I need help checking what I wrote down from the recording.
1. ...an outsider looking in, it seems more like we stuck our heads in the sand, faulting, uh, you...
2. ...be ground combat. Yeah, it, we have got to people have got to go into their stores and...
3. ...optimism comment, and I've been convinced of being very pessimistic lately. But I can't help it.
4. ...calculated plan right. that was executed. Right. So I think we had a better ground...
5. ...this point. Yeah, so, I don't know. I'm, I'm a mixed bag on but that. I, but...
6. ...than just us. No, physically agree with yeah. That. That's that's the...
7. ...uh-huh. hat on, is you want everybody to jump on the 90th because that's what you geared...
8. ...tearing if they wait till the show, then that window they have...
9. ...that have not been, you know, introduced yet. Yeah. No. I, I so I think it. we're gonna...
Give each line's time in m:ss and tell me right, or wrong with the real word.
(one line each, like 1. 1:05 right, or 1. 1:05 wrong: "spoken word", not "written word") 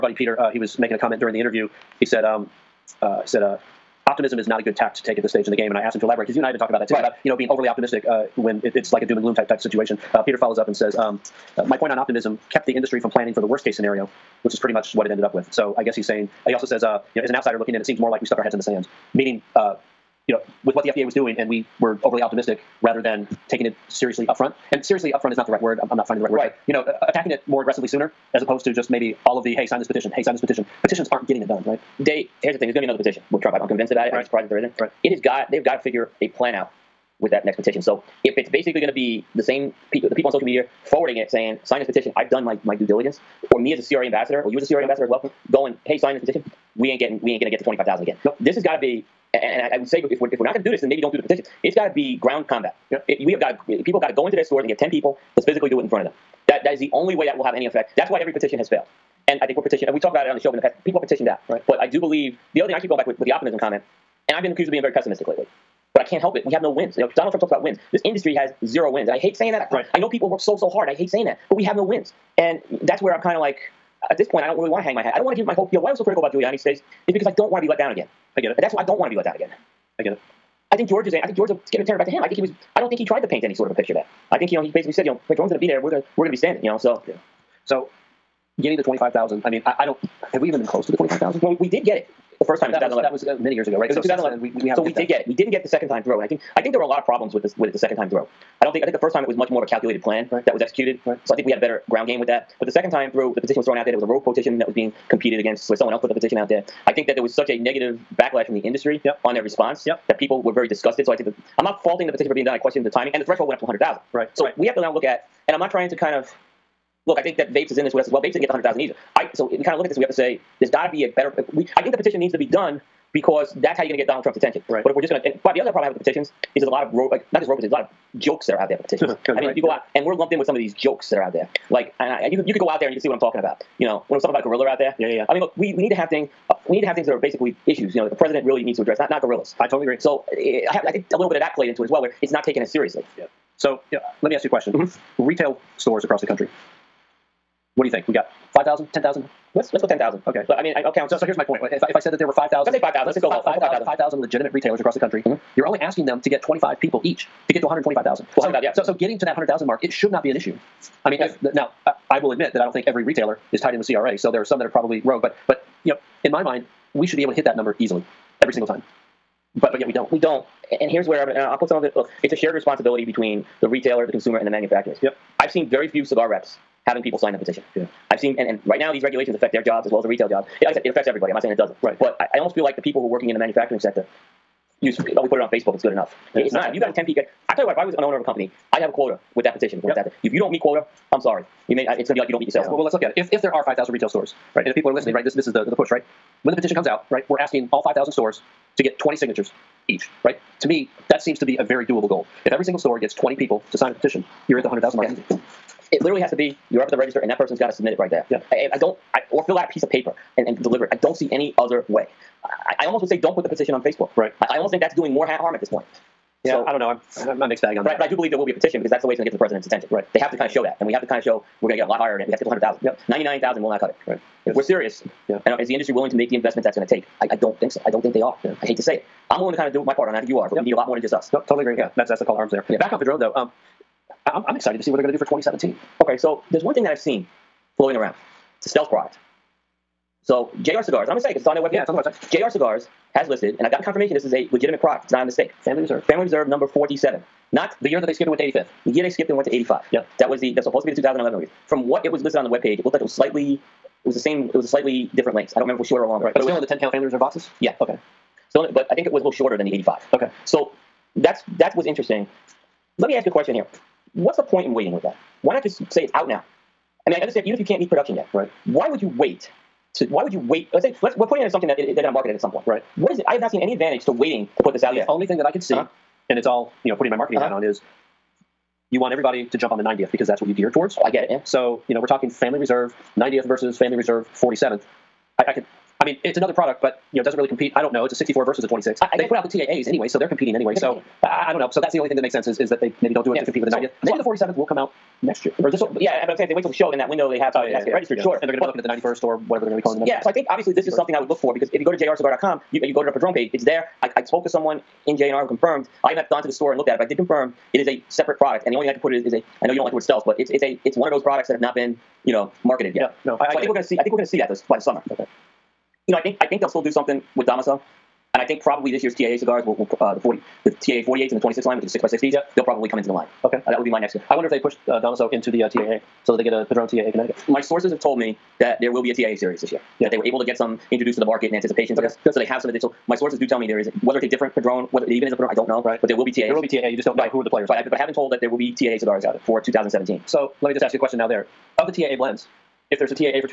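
1. 0:17 wrong: "meaning", not "faulting"
2. 0:51 right
3. 1:03 wrong: "accused", not "convinced"
4. 1:39 right
5. 3:35 right
6. 3:50 wrong: "totally", not "physically"
7. 4:37 right
8. 4:56 wrong: "saying", not "tearing"
9. 5:11 wrong: "marketed", not "introduced".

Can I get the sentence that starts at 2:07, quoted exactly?
petitions, a lot of jokes that are out there for petitions.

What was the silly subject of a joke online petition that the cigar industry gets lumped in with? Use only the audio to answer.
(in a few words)
a gorilla.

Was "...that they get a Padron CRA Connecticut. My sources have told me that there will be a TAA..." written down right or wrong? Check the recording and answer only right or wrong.
wrong.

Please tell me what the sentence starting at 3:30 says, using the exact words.
I don't see any other way.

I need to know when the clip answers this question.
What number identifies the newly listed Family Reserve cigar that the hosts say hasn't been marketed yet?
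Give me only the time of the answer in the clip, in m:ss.
4:06.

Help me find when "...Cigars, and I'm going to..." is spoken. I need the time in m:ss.
4:00.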